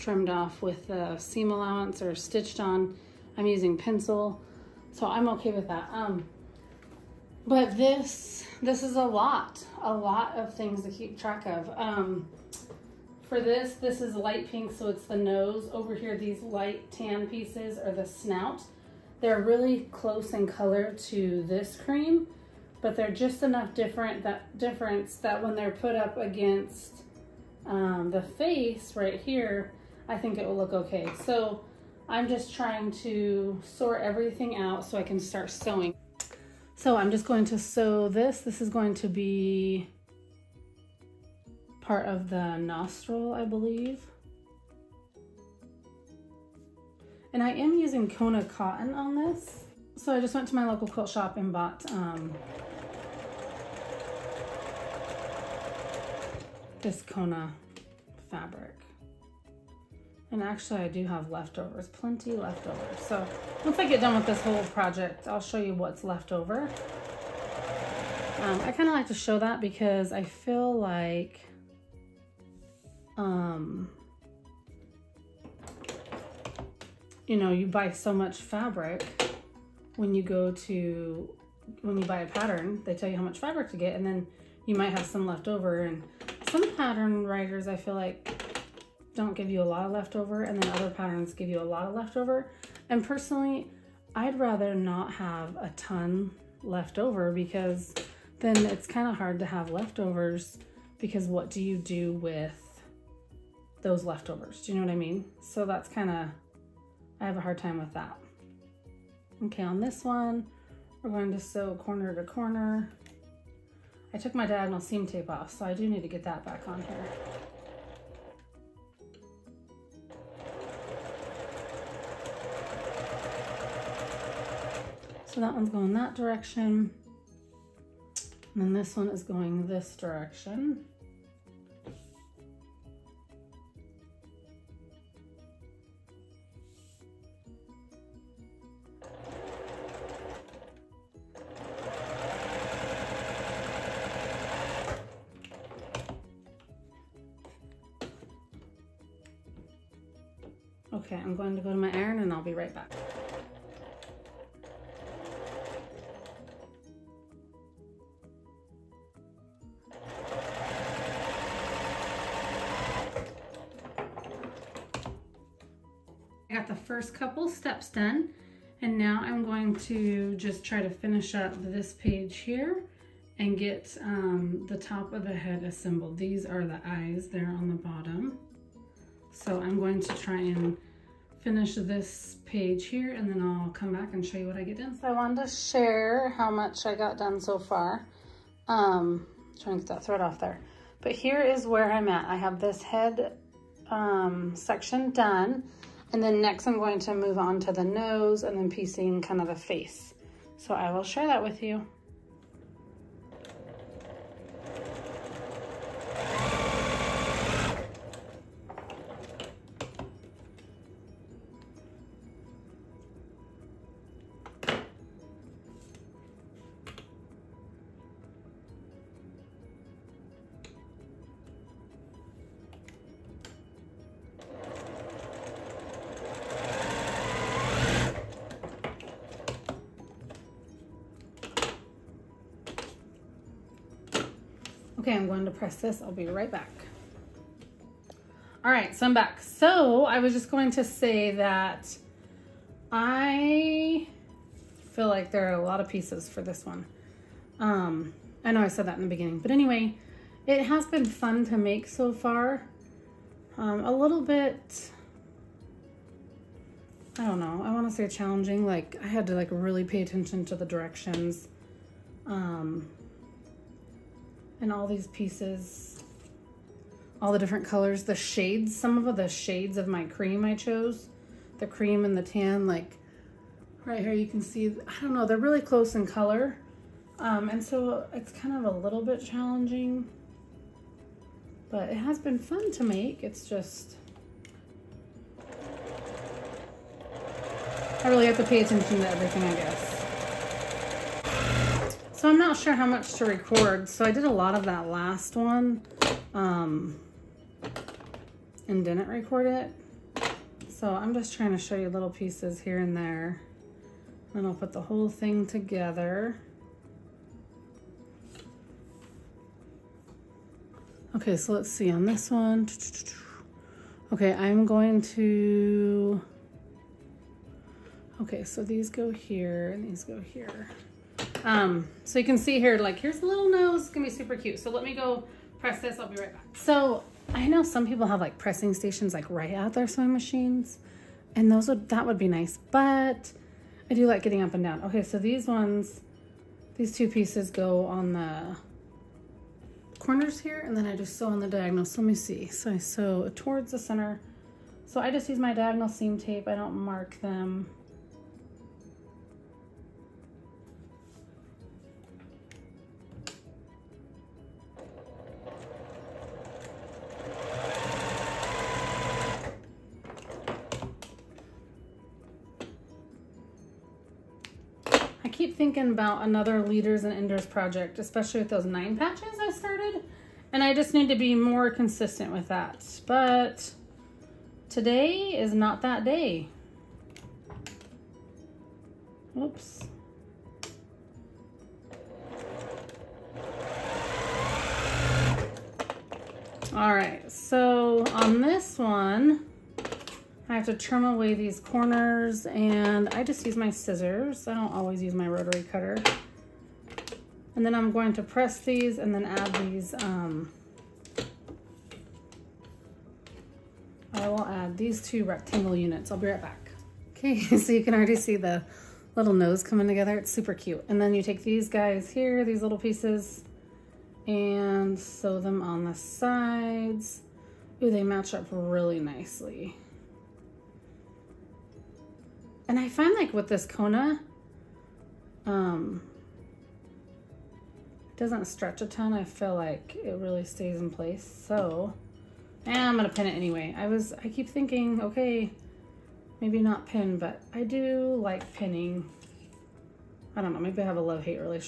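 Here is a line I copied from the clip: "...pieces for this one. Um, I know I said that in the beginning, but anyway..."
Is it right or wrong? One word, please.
right.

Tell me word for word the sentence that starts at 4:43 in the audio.
It's just, I really have to pay attention to everything, I guess.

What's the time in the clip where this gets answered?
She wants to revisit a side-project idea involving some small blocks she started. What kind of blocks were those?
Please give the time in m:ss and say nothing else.
6:08.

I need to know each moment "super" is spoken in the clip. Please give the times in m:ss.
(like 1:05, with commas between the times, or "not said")
5:24, 6:50.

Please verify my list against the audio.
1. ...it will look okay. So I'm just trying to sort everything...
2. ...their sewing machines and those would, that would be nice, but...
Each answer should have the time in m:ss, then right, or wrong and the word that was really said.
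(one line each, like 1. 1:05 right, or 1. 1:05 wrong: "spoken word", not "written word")
1. 0:30 right
2. 5:29 right.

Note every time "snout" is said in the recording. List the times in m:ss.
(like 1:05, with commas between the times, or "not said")
0:18.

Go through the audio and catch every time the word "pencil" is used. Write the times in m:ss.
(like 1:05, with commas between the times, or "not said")
0:03.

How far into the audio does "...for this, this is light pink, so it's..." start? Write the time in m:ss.
0:13.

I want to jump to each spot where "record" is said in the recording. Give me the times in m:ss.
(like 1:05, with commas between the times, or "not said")
4:53, 4:59.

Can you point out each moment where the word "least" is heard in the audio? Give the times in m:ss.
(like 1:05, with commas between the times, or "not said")
not said.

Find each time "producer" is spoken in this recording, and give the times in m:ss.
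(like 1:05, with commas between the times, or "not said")
not said.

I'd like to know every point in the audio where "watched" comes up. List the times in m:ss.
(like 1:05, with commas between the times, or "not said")
not said.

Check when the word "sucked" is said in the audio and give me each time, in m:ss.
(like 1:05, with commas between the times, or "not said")
not said.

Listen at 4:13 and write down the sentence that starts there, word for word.
Um, a little bit, I don't know, I want to say challenging.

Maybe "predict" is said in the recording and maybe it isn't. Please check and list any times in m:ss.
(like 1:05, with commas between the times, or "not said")
not said.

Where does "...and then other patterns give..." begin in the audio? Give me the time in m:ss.
1:30.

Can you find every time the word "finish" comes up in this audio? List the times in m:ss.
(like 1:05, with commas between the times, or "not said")
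2:50, 3:01.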